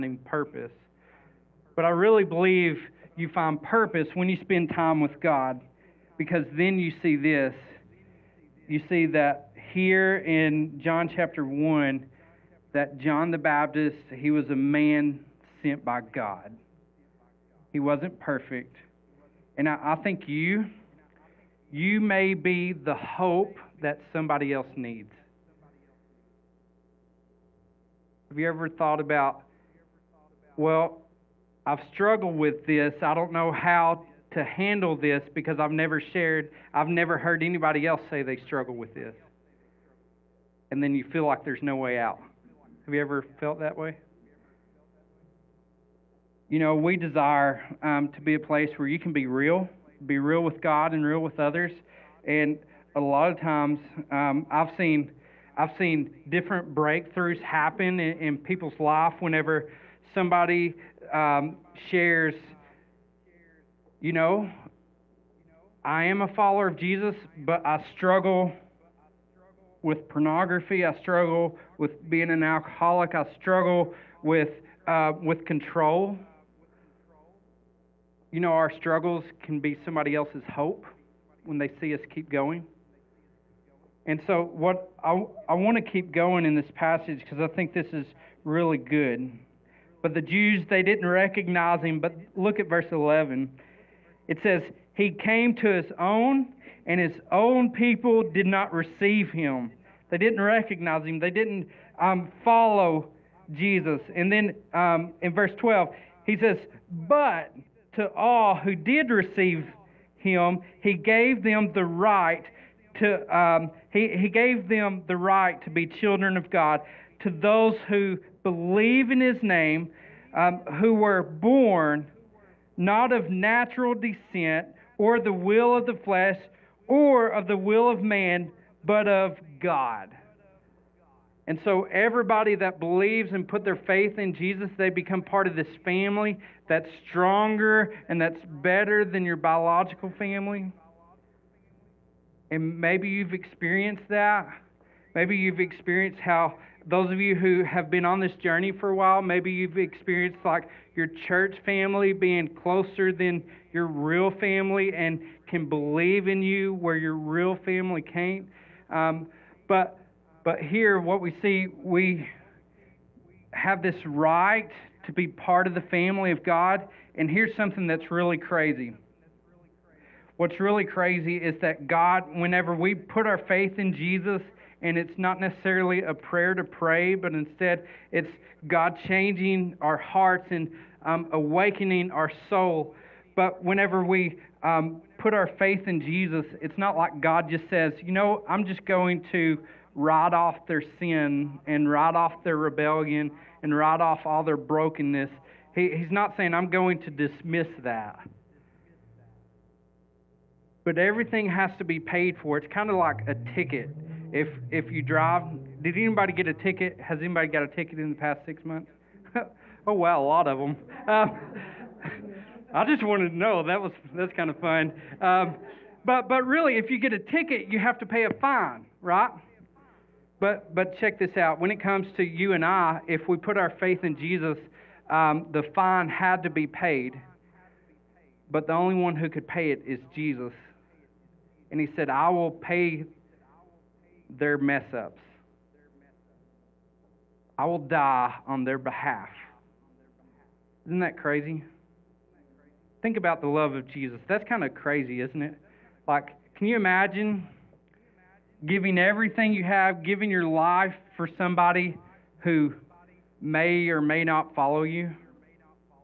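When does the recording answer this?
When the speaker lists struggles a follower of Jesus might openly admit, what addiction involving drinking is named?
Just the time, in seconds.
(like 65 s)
72 s.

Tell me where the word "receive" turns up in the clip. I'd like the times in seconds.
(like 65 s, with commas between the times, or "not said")
98 s, 109 s.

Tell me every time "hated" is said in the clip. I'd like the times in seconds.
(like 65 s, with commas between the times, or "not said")
not said.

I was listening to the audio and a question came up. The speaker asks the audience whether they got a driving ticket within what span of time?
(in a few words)
past 6 months.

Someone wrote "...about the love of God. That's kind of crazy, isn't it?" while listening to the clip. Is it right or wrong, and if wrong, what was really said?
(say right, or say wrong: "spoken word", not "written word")
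wrong: "Jesus", not "God".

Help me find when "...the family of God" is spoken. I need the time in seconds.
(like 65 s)
165 s.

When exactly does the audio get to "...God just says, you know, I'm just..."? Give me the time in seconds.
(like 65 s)
187 s.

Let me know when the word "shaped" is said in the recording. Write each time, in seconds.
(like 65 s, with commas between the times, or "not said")
not said.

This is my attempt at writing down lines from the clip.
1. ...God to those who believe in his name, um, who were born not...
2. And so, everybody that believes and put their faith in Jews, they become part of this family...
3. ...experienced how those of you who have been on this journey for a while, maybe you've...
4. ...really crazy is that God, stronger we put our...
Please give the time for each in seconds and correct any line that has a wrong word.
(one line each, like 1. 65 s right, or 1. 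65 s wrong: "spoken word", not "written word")
1. 116 s right
2. 131 s wrong: "Jesus", not "Jews"
3. 145 s right
4. 170 s wrong: "whenever", not "stronger".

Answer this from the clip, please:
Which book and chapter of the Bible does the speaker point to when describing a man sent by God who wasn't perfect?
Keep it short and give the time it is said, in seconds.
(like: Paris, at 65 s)
John chapter 1, at 10 s.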